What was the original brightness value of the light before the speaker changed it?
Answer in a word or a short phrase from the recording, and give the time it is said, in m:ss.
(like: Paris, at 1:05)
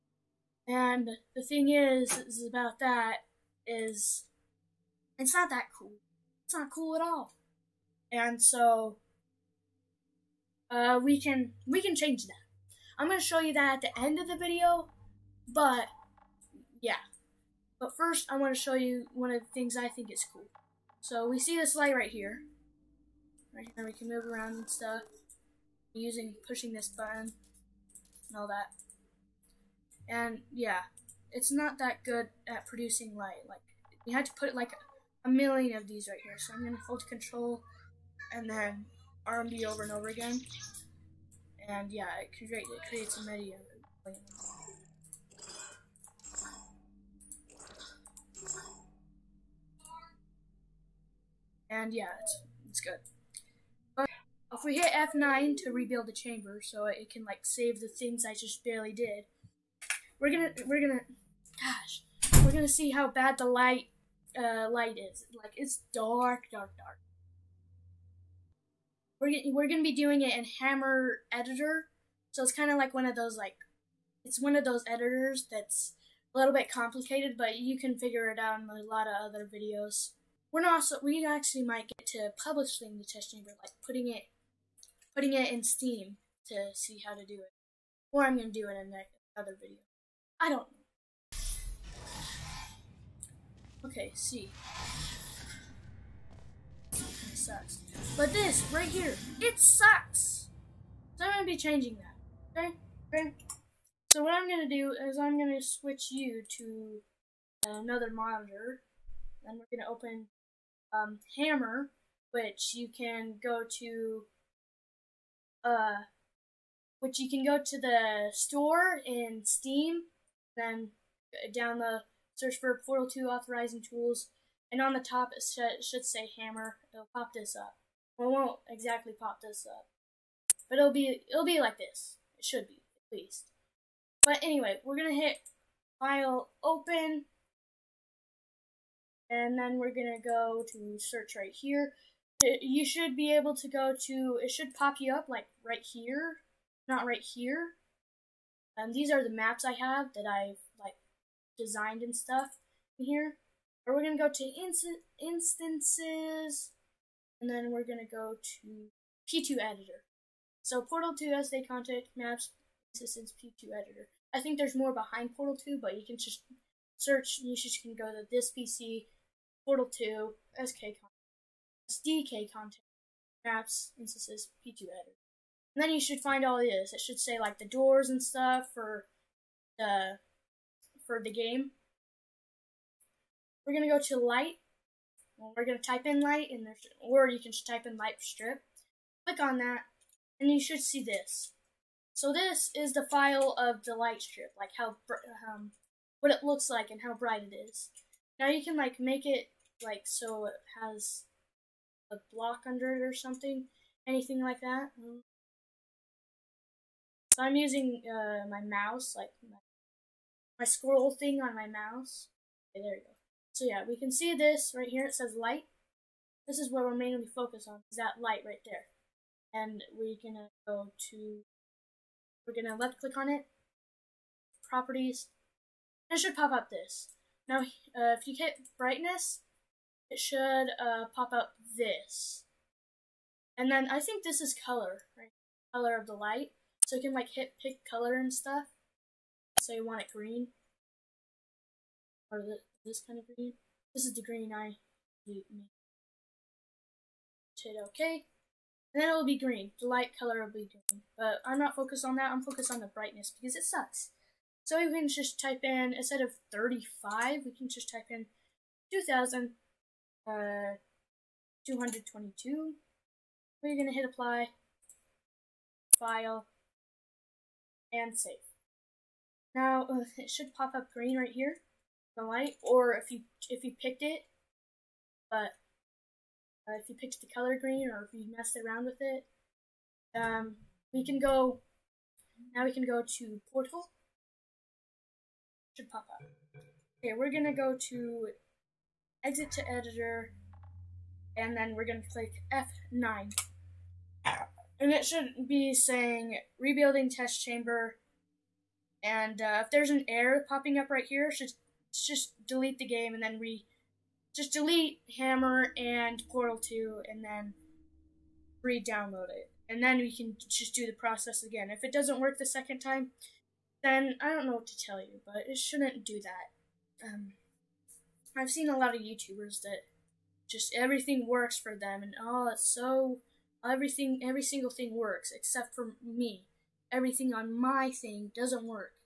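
35, at 4:16.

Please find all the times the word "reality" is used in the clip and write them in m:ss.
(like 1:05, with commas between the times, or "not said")
not said.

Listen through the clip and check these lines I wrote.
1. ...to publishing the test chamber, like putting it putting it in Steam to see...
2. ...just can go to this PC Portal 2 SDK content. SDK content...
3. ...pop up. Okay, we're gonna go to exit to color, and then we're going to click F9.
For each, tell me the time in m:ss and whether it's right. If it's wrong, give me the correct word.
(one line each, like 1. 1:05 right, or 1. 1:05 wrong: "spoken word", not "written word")
1. 1:22 right
2. 2:47 right
3. 4:45 wrong: "editor", not "color".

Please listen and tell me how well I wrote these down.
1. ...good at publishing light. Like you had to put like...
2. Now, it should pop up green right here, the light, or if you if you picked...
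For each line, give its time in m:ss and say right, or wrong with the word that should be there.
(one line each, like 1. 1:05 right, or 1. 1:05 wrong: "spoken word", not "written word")
1. 0:32 wrong: "producing", not "publishing"
2. 4:29 right.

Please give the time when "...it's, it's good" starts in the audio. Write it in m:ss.
0:52.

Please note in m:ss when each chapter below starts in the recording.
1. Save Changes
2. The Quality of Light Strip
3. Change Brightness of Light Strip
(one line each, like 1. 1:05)
1. 4:40
2. 0:19
3. 1:48.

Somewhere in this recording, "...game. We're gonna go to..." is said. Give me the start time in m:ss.
3:01.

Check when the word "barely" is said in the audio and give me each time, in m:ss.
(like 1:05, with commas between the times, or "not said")
0:58.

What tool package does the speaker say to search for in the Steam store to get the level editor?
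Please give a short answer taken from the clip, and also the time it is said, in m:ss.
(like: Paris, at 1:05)
Portal 2 Authoring Tools, at 2:02.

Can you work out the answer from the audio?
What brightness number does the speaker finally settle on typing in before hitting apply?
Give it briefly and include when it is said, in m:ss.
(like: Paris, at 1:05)
222, at 4:21.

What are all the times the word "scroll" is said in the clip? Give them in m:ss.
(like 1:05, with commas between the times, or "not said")
3:30.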